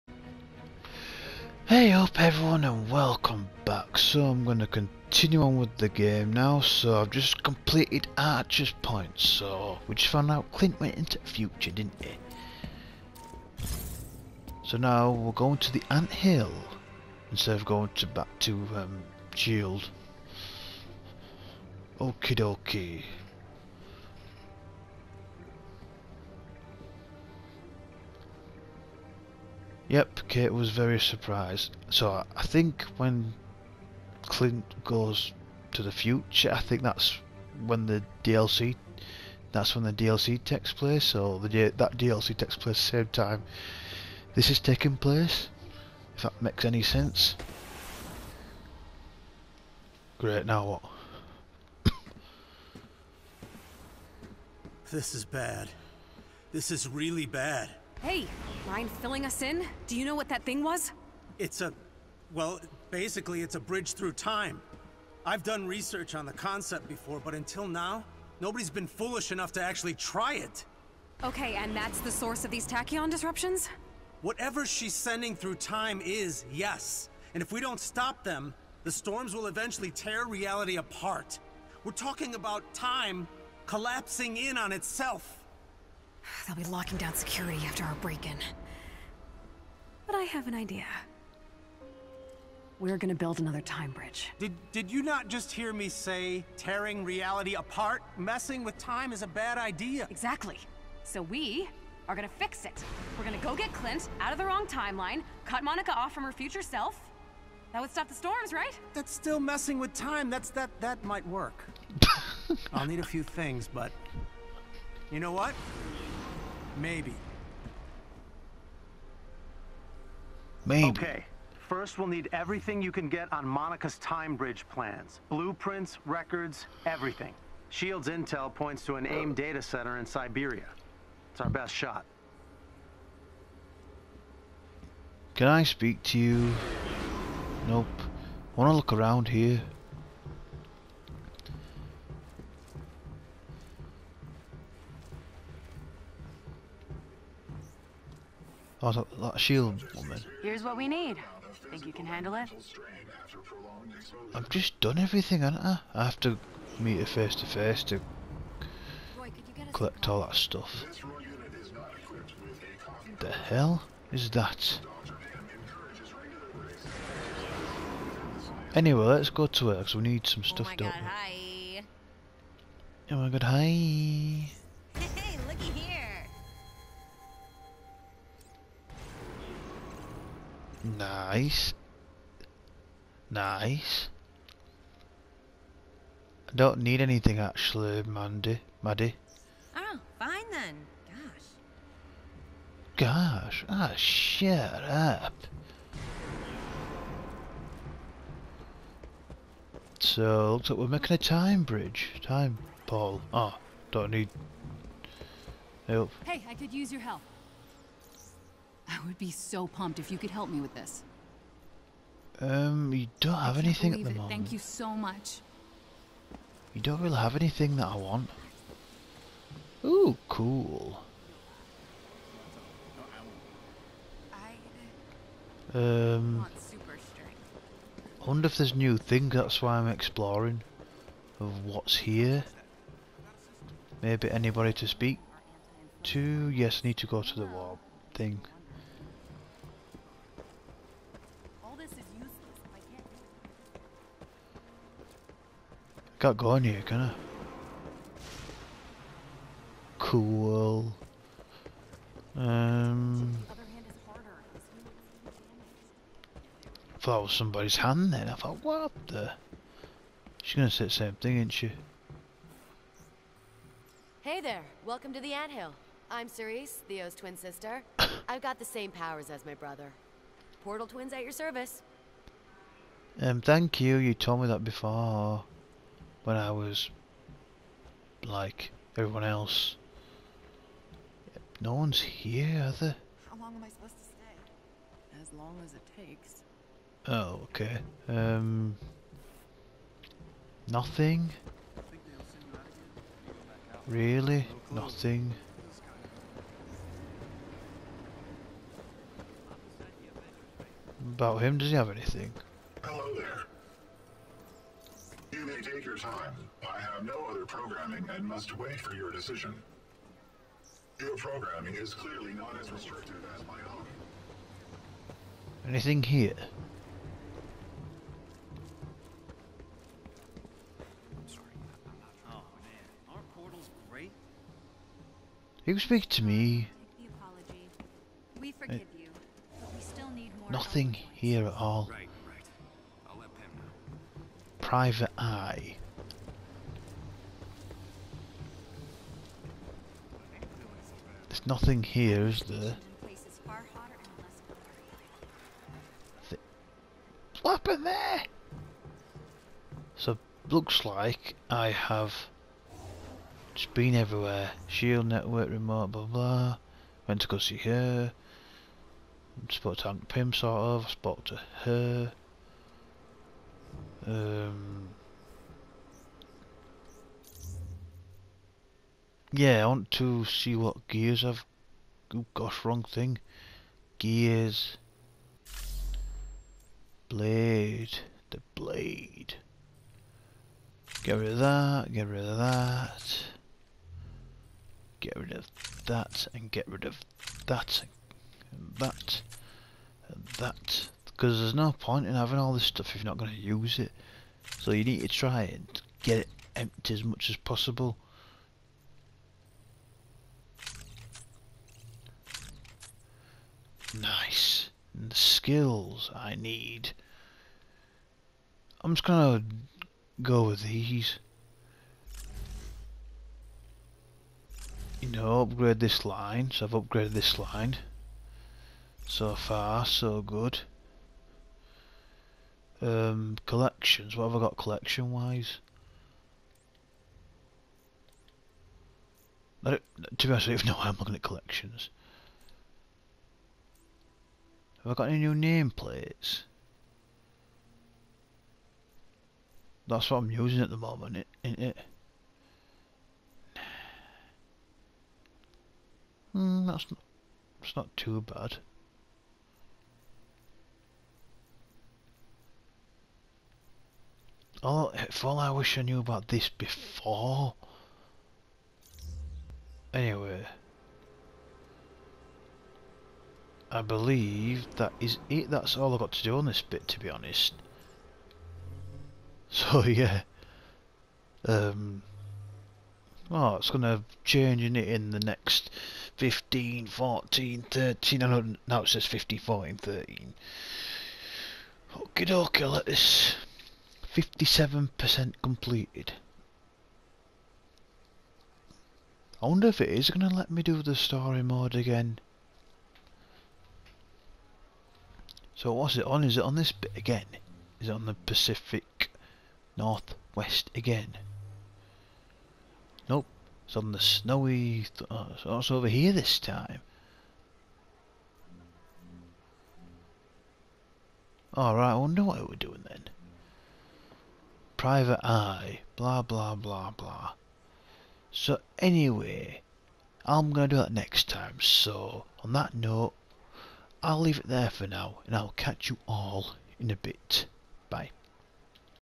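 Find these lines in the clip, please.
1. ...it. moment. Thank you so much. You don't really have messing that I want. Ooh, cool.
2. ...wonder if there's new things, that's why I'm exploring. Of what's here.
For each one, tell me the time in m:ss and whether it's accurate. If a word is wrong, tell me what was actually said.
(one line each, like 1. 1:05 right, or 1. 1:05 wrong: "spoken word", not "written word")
1. 3:34 wrong: "anything", not "messing"
2. 3:48 right.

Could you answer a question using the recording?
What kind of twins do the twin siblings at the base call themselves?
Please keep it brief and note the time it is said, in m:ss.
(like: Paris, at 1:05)
Portal twins, at 4:30.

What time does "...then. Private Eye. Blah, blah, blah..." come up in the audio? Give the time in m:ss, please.
8:32.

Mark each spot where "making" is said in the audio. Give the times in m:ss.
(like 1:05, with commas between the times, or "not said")
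3:20.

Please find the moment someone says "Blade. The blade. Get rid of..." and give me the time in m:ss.
6:17.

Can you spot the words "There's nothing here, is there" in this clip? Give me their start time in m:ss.
5:41.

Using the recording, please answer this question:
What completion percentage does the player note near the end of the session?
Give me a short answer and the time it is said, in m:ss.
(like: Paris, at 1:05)
57%, at 8:04.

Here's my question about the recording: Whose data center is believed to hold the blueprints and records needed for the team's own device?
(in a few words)
AIM.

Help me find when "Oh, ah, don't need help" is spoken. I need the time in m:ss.
3:23.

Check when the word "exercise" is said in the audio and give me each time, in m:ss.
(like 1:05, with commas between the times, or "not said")
not said.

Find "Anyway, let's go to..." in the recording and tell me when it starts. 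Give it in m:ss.
2:48.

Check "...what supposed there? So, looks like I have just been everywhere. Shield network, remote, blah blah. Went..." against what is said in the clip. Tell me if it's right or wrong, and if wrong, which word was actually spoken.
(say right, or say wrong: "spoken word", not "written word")
wrong: "happened", not "supposed".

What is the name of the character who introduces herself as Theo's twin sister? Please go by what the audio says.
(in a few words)
Cerise.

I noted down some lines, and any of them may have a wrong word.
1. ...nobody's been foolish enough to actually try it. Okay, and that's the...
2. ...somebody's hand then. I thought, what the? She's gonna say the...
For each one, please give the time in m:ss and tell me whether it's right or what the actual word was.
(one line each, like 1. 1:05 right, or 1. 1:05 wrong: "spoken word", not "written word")
1. 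1:08 right
2. 4:17 right.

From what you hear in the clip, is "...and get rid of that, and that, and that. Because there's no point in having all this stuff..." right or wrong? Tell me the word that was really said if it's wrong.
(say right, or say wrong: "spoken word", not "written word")
right.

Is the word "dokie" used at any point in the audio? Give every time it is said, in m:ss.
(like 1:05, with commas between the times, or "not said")
0:22, 8:02.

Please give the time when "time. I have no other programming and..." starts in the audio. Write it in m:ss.
5:06.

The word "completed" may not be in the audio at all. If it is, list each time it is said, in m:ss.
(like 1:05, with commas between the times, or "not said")
0:07, 8:05.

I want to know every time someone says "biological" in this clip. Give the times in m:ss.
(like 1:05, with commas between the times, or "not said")
not said.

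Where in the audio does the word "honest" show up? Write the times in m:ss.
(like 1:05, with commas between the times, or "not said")
7:10, 7:47.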